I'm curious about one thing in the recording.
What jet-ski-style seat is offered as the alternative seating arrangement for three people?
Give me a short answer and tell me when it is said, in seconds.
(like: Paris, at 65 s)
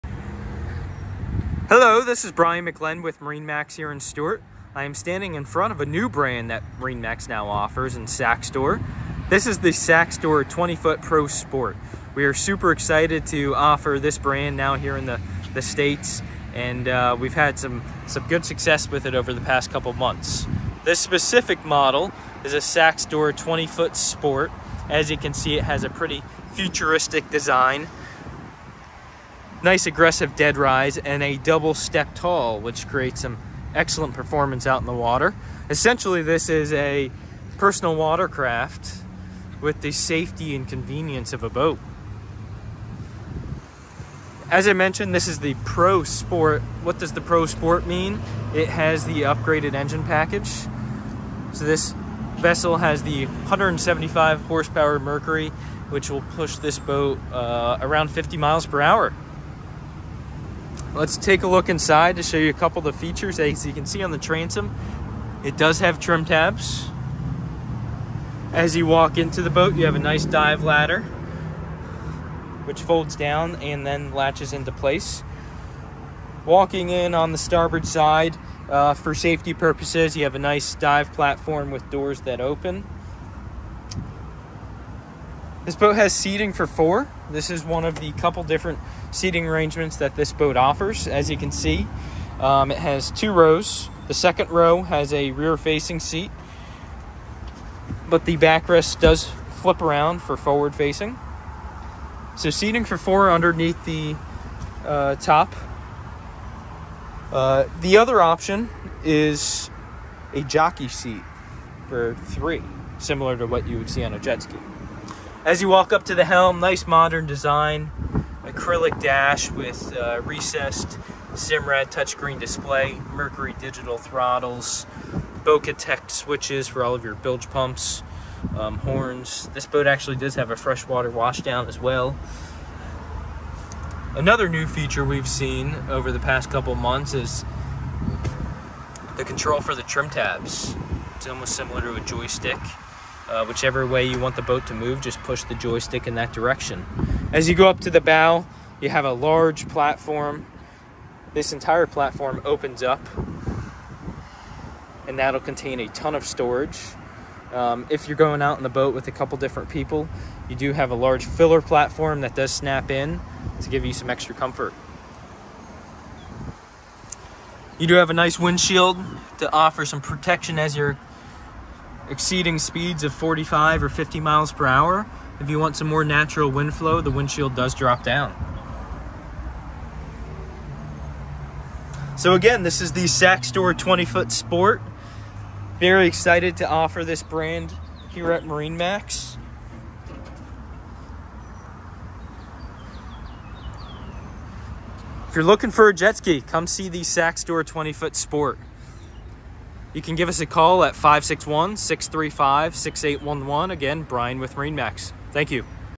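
Jockey seat, at 110 s.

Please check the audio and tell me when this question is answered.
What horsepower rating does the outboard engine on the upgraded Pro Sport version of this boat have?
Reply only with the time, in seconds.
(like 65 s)
53 s.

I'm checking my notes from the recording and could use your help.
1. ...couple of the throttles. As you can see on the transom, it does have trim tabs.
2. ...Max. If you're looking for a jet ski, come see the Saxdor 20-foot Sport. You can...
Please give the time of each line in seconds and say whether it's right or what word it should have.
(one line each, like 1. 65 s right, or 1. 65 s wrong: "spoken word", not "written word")
1. 62 s wrong: "features", not "throttles"
2. 188 s right.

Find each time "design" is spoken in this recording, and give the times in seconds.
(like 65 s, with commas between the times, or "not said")
27 s, 117 s.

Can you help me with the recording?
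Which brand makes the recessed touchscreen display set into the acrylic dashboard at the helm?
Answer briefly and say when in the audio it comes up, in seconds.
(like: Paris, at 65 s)
Simrad, at 121 s.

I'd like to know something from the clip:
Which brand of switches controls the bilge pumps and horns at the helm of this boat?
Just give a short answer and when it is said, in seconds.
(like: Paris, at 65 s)
Bocatech, at 125 s.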